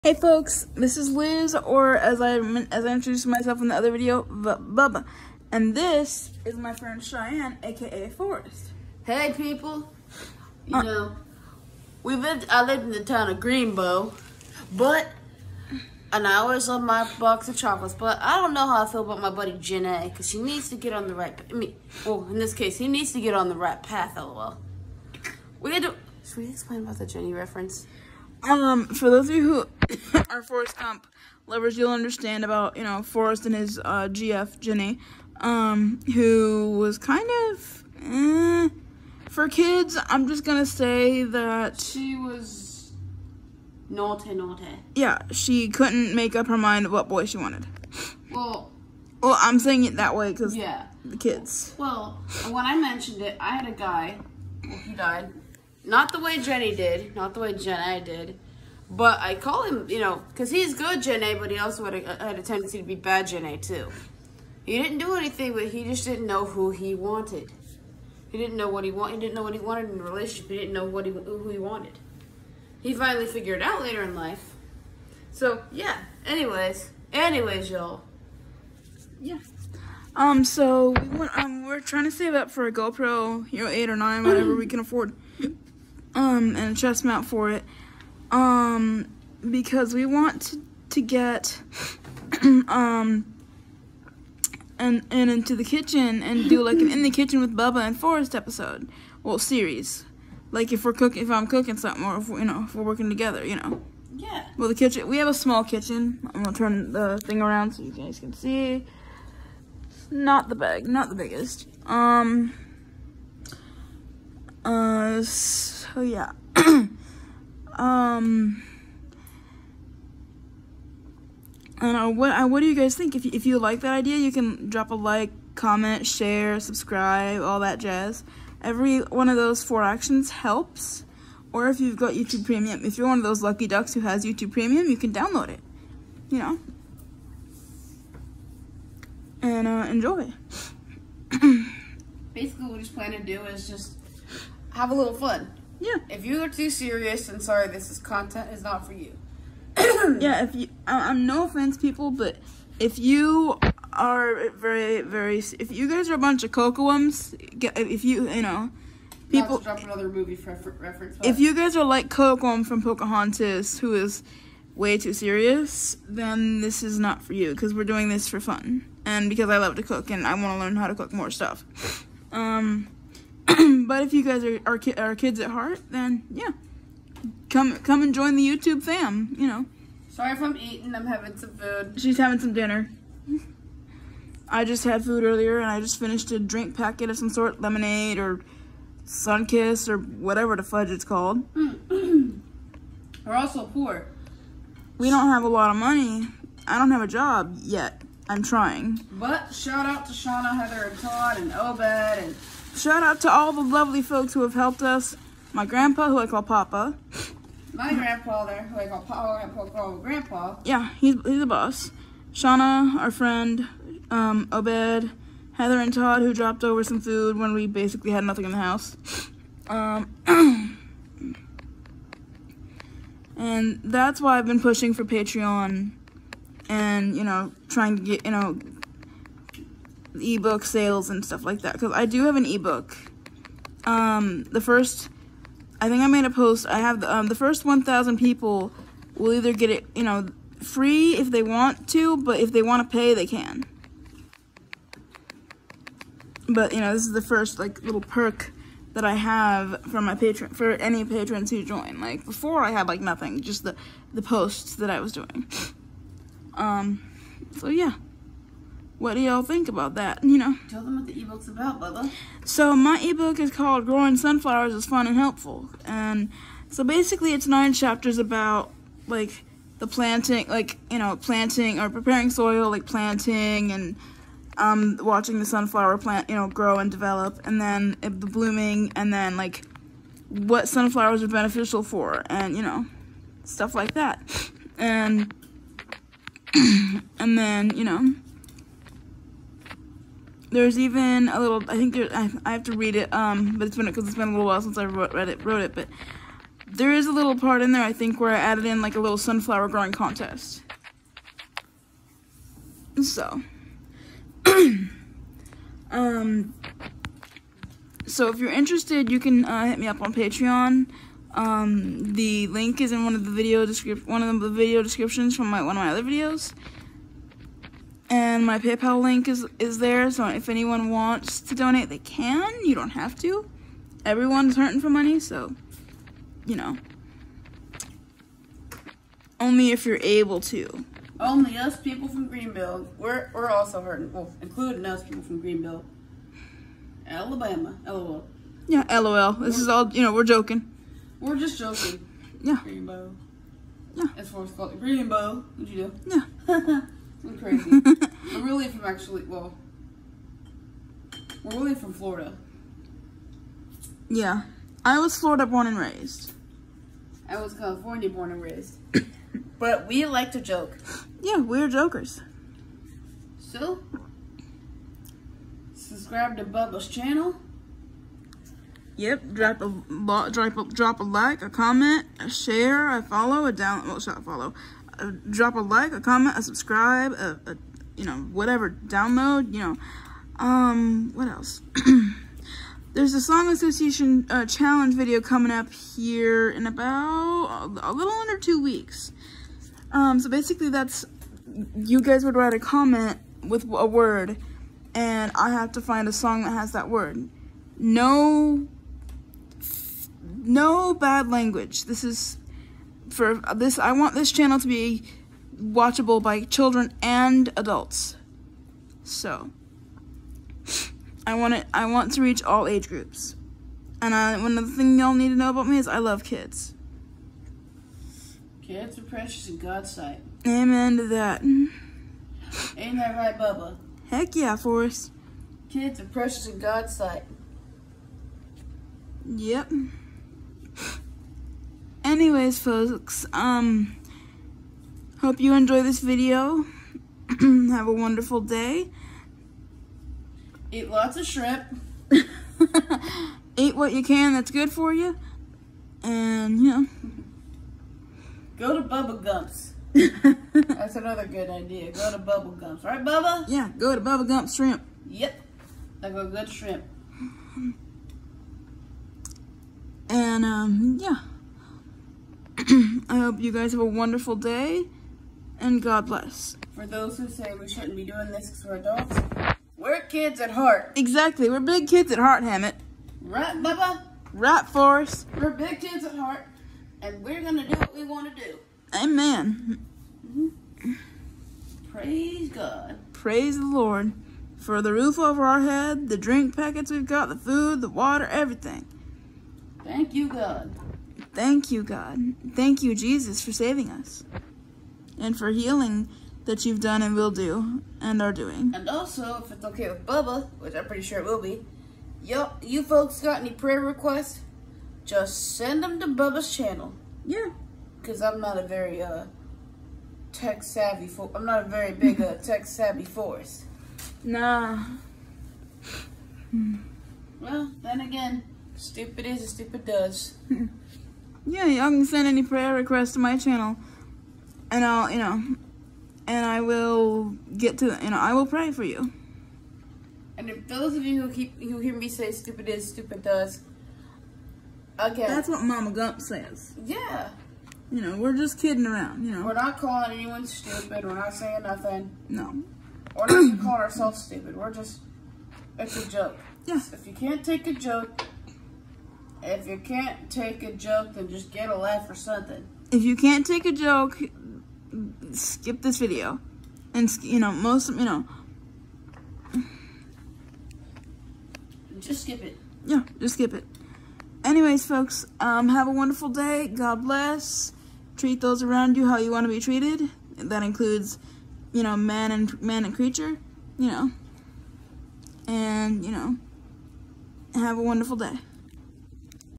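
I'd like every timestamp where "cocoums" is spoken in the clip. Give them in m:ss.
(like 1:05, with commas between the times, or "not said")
2:36, 2:42.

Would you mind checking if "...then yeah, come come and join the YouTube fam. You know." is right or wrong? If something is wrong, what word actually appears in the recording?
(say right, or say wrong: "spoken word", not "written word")
right.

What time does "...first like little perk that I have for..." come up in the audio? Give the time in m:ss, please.
4:07.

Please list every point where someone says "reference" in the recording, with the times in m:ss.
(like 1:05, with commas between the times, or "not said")
0:27, 2:40.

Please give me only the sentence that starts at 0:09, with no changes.
Hey people, you uh, know, we lived.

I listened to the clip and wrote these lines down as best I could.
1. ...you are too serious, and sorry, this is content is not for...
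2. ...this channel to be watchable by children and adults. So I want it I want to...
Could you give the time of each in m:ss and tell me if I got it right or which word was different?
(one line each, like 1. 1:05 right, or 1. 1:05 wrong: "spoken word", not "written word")
1. 2:26 right
2. 6:44 right.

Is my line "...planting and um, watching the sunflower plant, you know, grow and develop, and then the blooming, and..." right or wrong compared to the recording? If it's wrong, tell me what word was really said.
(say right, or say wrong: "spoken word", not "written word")
right.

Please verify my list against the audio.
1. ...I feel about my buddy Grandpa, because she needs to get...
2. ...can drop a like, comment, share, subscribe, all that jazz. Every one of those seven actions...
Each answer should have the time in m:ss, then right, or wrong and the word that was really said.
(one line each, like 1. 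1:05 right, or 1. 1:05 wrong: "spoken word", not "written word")
1. 0:18 wrong: "Jenna", not "Grandpa"
2. 2:04 wrong: "four", not "seven".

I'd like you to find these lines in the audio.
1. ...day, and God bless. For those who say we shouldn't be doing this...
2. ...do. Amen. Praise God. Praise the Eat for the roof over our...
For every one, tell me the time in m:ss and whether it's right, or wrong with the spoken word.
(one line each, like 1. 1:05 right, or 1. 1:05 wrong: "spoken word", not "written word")
1. 7:44 right
2. 7:58 wrong: "Lord", not "Eat".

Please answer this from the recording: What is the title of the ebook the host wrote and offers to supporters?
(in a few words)
Growing Sunflowers is Fun and Helpful.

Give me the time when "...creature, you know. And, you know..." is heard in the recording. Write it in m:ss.
9:32.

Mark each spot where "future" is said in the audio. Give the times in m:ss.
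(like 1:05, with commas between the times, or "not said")
not said.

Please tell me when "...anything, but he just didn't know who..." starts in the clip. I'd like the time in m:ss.
1:05.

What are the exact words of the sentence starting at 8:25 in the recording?
Just send them to Bubba's channel.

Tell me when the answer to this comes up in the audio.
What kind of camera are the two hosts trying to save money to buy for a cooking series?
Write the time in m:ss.
1:22.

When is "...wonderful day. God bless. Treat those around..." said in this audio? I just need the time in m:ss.
9:25.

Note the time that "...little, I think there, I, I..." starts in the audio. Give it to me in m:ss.
4:51.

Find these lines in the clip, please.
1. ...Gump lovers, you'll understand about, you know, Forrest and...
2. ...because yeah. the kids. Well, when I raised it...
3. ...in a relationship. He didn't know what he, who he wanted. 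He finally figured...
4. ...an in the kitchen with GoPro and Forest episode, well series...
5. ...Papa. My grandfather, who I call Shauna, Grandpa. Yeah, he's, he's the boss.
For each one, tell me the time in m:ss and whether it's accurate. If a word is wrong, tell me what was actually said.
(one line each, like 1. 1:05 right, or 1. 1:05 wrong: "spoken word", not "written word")
1. 0:30 right
2. 0:50 wrong: "mentioned", not "raised"
3. 1:09 right
4. 1:36 wrong: "Bubba", not "GoPro"
5. 3:26 wrong: "Papa", not "Shauna".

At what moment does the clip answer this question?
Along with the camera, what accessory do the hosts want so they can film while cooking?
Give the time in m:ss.
1:26.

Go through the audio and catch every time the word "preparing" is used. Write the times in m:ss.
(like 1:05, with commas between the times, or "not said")
4:31.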